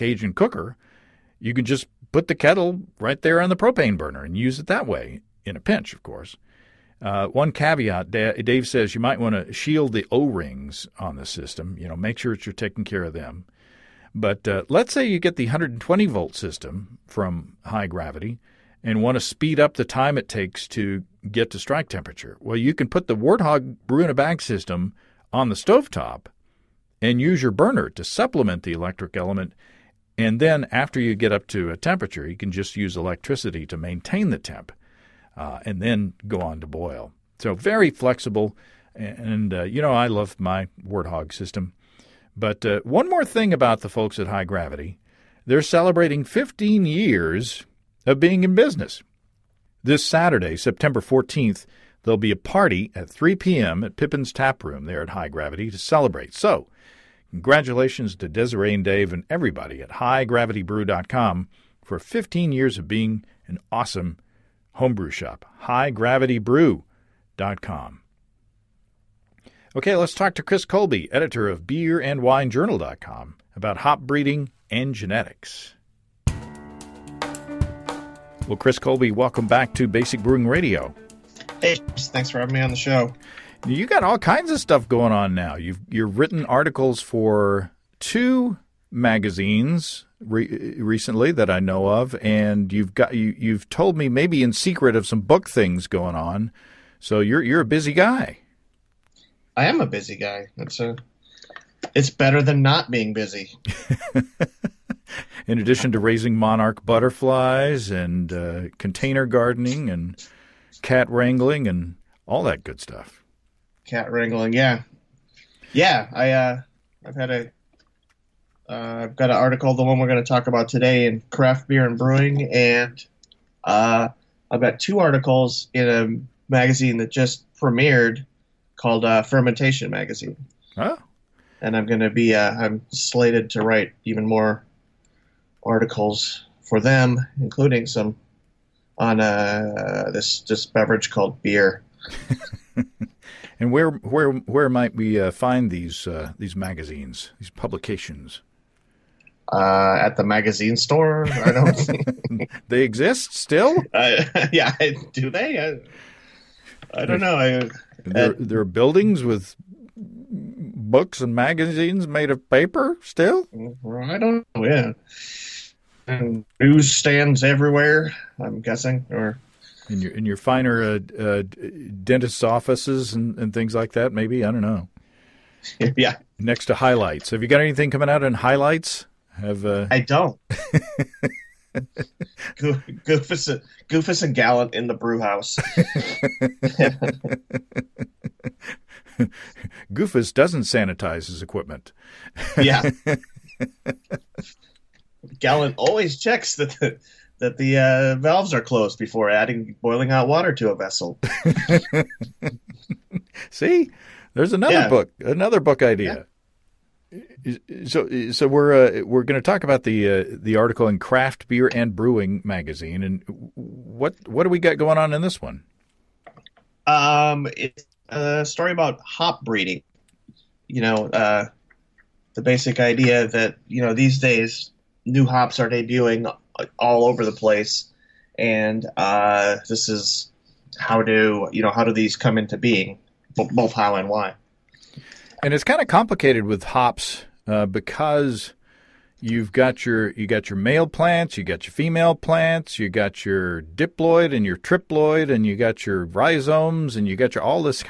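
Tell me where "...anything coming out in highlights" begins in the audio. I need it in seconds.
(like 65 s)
177 s.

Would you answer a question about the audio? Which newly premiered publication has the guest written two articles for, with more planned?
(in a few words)
Fermentation Magazine.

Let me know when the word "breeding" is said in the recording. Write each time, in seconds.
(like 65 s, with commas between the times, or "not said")
74 s, 219 s.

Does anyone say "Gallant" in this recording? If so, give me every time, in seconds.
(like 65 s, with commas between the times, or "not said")
184 s, 195 s.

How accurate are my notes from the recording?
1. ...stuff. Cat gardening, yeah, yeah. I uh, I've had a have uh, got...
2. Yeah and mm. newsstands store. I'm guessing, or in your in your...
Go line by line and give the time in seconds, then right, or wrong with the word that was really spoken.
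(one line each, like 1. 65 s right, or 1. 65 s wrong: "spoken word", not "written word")
1. 112 s wrong: "wrangling", not "gardening"
2. 164 s wrong: "everywhere", not "store".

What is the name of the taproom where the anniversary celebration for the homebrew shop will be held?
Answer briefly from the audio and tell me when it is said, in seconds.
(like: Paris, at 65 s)
Pippin's Tap Room, at 53 s.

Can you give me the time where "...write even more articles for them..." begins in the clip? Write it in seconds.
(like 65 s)
133 s.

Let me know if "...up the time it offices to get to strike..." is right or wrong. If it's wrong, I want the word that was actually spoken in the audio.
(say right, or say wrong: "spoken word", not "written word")
wrong: "takes", not "offices".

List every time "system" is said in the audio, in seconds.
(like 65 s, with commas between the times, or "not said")
11 s, 16 s, 24 s, 41 s.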